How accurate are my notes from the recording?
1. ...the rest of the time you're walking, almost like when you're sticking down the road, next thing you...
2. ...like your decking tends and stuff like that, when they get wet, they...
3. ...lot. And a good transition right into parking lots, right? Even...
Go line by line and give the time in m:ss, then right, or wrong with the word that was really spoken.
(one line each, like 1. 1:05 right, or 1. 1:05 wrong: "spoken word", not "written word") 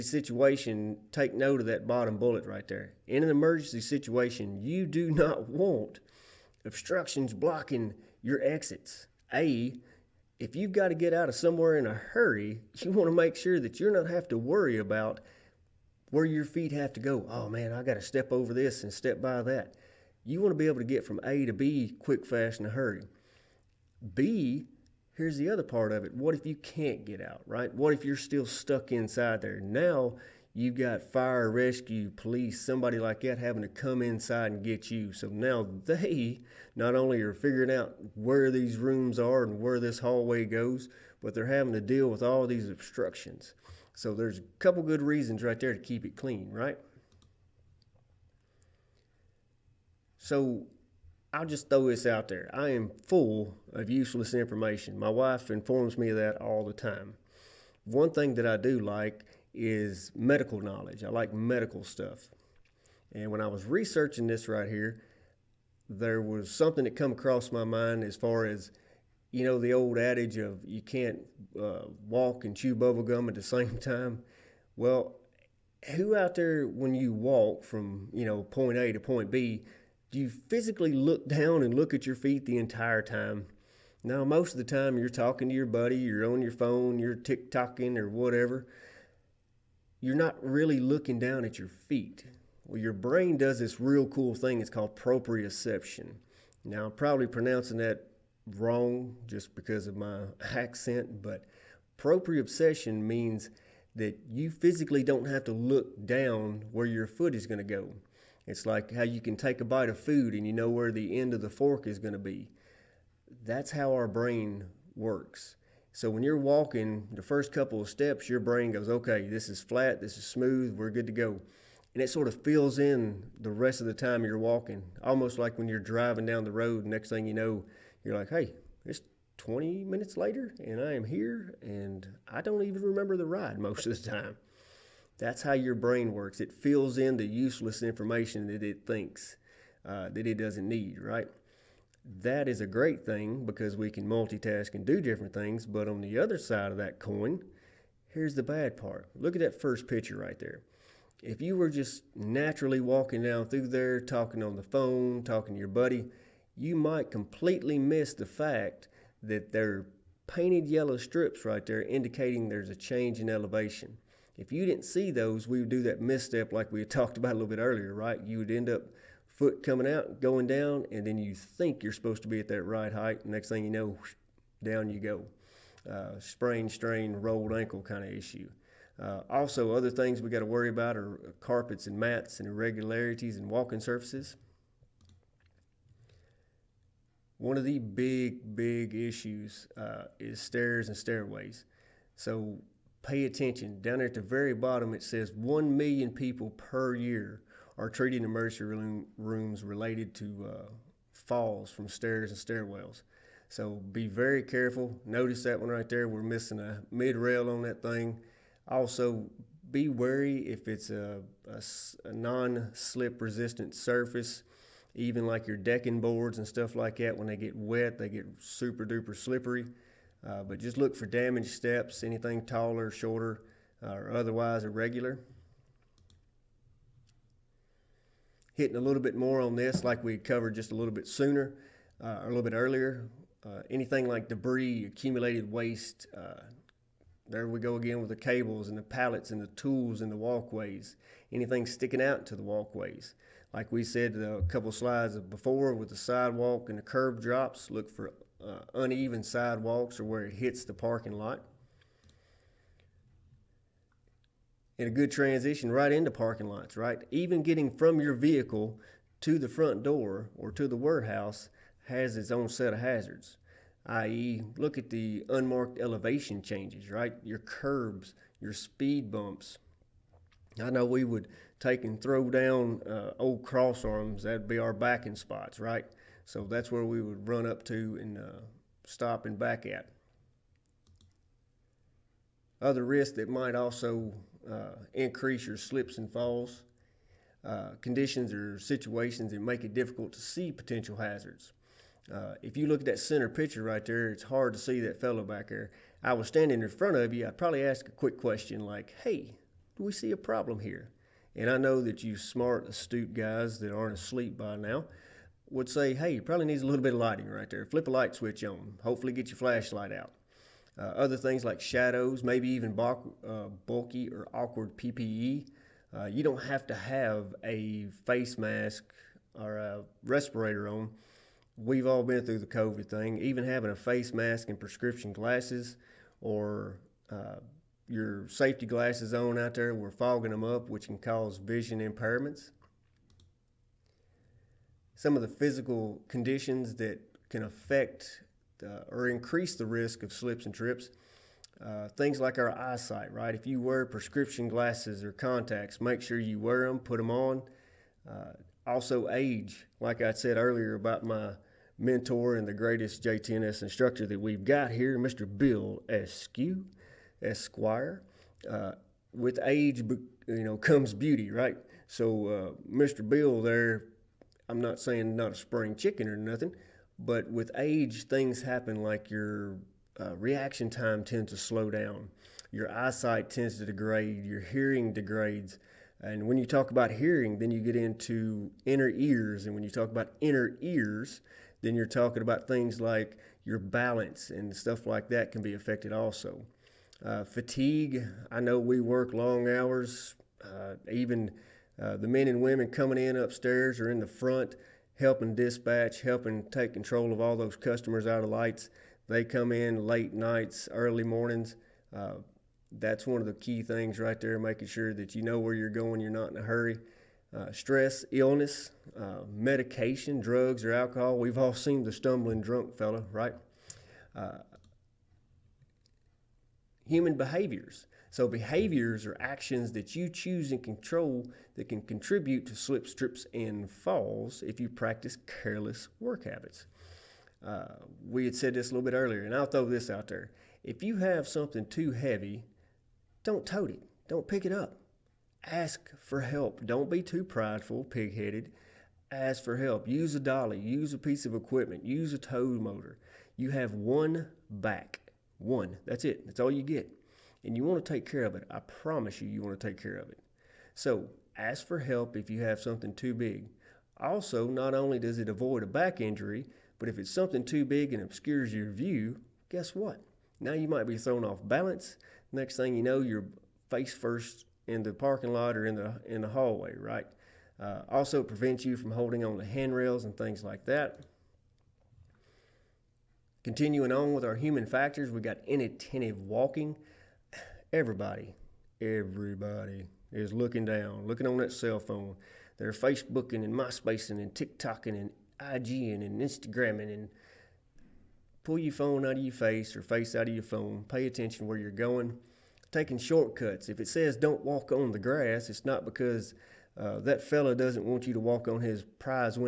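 1. 2:03 wrong: "driving", not "sticking"
2. 3:35 wrong: "boards", not "tends"
3. 4:11 right.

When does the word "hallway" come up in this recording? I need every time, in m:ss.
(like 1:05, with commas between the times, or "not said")
0:39, 7:46.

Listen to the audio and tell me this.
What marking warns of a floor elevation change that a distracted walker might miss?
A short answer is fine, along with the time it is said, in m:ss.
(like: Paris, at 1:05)
Painted yellow strips, at 2:40.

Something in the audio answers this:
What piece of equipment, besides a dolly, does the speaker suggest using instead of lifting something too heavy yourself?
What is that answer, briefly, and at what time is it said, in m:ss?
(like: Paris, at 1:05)
Tow motor, at 7:22.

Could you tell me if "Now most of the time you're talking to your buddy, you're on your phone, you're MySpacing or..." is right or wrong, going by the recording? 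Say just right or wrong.
wrong.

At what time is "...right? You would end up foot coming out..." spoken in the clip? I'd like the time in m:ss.
2:47.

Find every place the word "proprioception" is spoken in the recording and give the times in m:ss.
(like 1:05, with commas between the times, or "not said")
1:34, 1:41.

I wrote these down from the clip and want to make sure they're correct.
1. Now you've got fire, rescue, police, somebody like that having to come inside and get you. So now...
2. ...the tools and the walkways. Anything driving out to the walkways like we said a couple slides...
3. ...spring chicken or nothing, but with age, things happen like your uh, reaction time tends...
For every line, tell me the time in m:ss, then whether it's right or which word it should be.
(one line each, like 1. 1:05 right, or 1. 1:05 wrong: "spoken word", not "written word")
1. 0:29 right
2. 3:59 wrong: "sticking", not "driving"
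3. 6:05 right.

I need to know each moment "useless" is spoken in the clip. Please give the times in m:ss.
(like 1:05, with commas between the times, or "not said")
0:53, 2:17.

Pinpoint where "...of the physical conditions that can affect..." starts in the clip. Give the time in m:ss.
5:35.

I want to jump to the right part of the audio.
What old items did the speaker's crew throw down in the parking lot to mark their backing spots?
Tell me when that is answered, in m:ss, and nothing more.
4:33.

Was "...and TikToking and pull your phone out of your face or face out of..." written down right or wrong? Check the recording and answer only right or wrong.
wrong.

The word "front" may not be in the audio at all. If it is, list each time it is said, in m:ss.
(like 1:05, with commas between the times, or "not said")
4:19, 4:56, 6:34.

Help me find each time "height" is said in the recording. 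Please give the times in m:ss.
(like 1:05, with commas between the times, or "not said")
2:52.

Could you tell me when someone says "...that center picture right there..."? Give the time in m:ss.
4:52.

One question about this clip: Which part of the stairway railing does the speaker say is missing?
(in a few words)
Mid rail.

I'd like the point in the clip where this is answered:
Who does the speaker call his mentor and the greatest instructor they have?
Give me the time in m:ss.
5:55.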